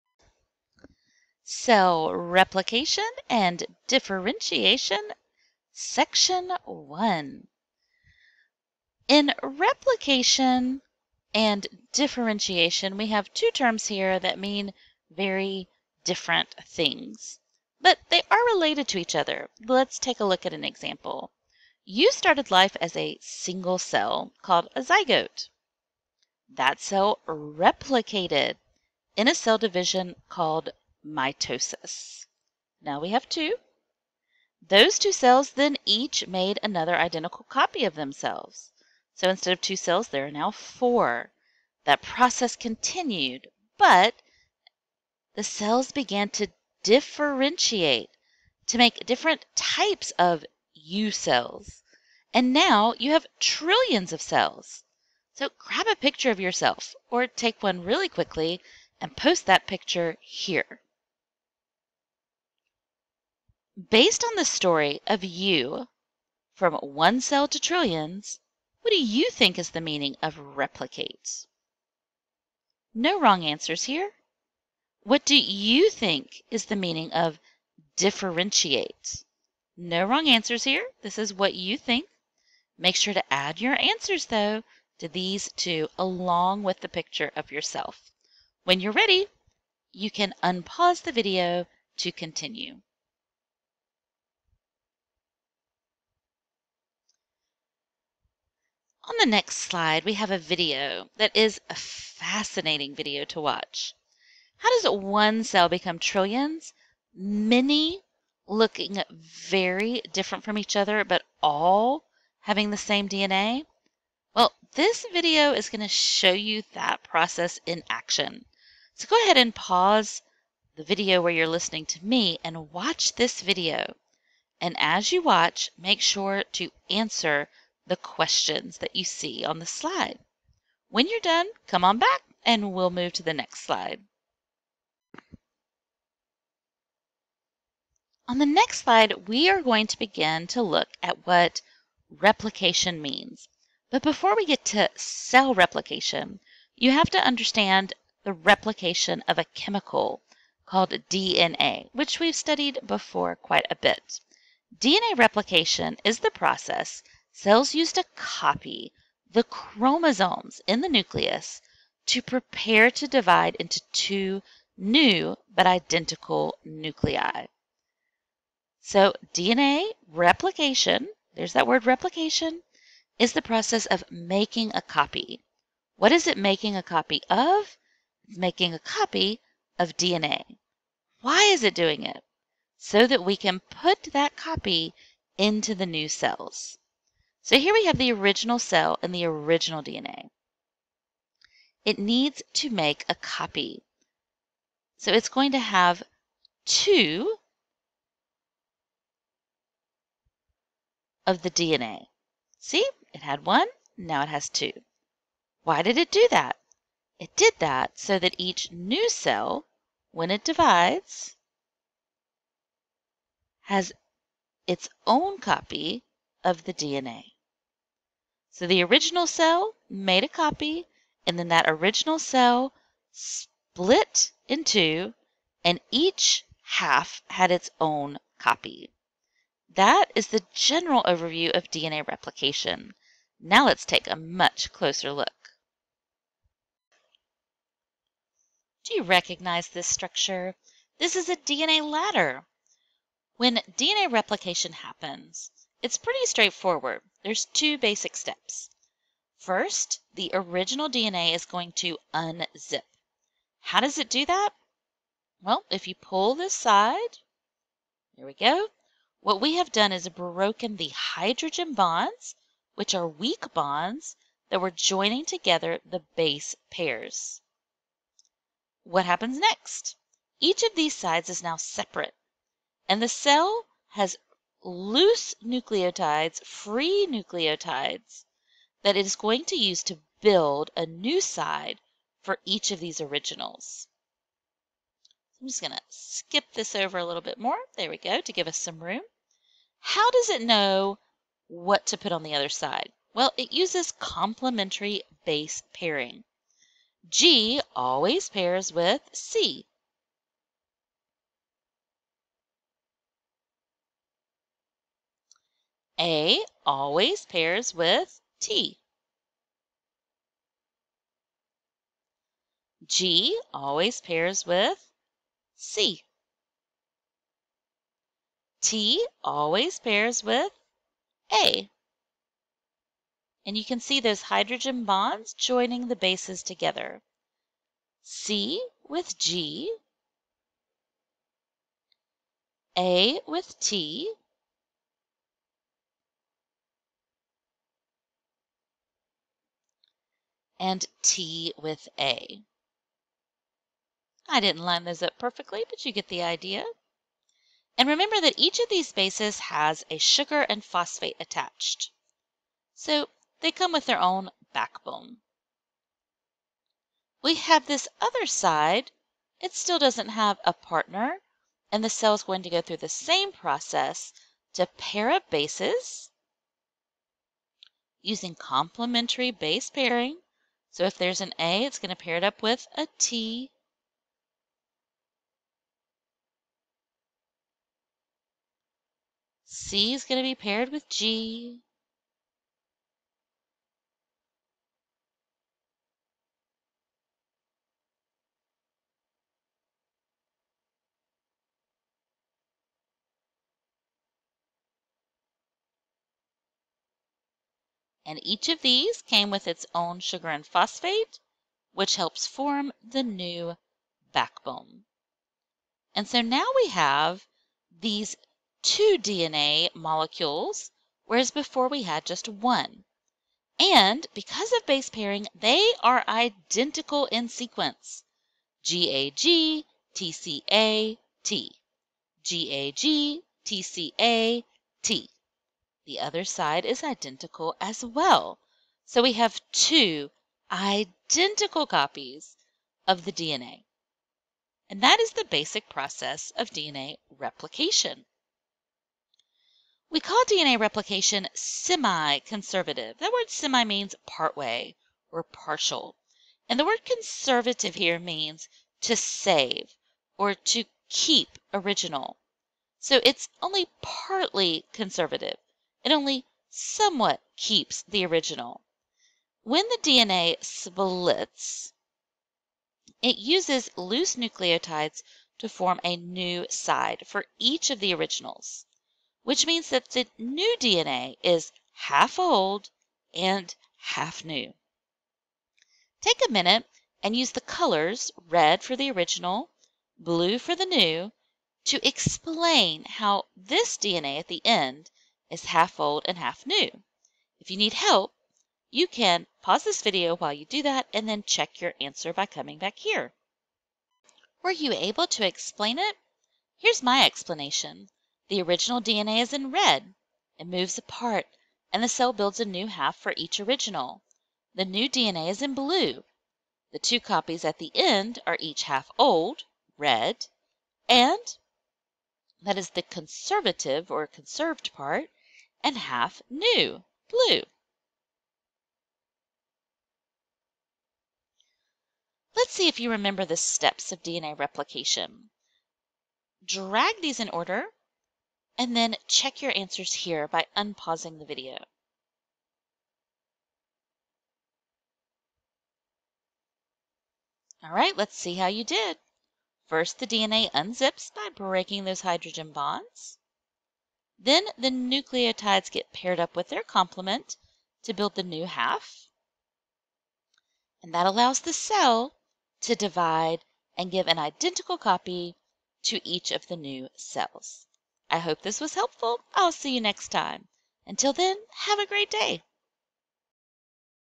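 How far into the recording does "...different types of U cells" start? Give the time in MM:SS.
00:49.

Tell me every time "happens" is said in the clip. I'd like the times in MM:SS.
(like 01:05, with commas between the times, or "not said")
04:04, 04:29.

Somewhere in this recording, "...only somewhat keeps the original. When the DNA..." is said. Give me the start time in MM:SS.
07:35.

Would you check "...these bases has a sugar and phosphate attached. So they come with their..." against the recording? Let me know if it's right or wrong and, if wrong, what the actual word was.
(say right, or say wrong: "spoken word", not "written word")
right.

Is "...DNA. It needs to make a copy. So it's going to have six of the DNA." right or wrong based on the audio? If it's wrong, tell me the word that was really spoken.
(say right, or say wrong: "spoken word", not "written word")
wrong: "two", not "six".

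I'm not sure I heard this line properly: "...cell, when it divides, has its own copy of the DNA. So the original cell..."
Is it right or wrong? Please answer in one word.
right.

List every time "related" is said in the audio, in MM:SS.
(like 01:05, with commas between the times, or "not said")
00:18.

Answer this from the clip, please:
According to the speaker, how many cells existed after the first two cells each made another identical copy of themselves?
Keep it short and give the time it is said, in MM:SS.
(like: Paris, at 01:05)
4, at 00:40.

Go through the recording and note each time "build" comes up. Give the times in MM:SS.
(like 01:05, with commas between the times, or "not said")
04:40, 08:22, 09:07.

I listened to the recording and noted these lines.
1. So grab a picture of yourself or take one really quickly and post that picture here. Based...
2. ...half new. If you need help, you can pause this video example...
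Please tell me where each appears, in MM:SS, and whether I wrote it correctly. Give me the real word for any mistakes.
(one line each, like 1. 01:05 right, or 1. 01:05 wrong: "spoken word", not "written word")
1. 00:55 right
2. 08:06 wrong: "while", not "example".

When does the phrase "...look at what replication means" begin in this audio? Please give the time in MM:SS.
02:20.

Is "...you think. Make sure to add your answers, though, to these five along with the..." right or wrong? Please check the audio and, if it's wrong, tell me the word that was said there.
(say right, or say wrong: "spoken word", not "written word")
wrong: "two", not "five".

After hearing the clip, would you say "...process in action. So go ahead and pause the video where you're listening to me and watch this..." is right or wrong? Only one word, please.
right.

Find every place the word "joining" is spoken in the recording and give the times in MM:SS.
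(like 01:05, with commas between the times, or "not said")
04:24, 05:25.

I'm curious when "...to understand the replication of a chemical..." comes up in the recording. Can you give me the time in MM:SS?
02:27.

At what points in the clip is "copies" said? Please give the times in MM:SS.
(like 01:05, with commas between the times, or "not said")
07:11, 08:26.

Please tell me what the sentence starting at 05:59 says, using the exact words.
It still doesn't have a partner.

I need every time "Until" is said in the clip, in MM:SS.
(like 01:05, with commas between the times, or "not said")
09:20.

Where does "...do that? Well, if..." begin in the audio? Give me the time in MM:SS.
04:14.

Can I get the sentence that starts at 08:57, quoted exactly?
All right, let's see how you did.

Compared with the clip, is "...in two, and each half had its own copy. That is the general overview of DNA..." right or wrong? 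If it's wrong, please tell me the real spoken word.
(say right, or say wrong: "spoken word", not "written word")
right.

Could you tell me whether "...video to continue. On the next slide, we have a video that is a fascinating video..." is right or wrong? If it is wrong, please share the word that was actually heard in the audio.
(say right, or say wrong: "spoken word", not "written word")
right.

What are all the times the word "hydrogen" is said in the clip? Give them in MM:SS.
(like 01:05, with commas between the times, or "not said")
04:20, 05:24, 09:02.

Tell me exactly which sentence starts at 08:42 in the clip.
Let's see if you remember the steps of DNA replication.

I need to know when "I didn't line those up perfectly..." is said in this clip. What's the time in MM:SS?
05:44.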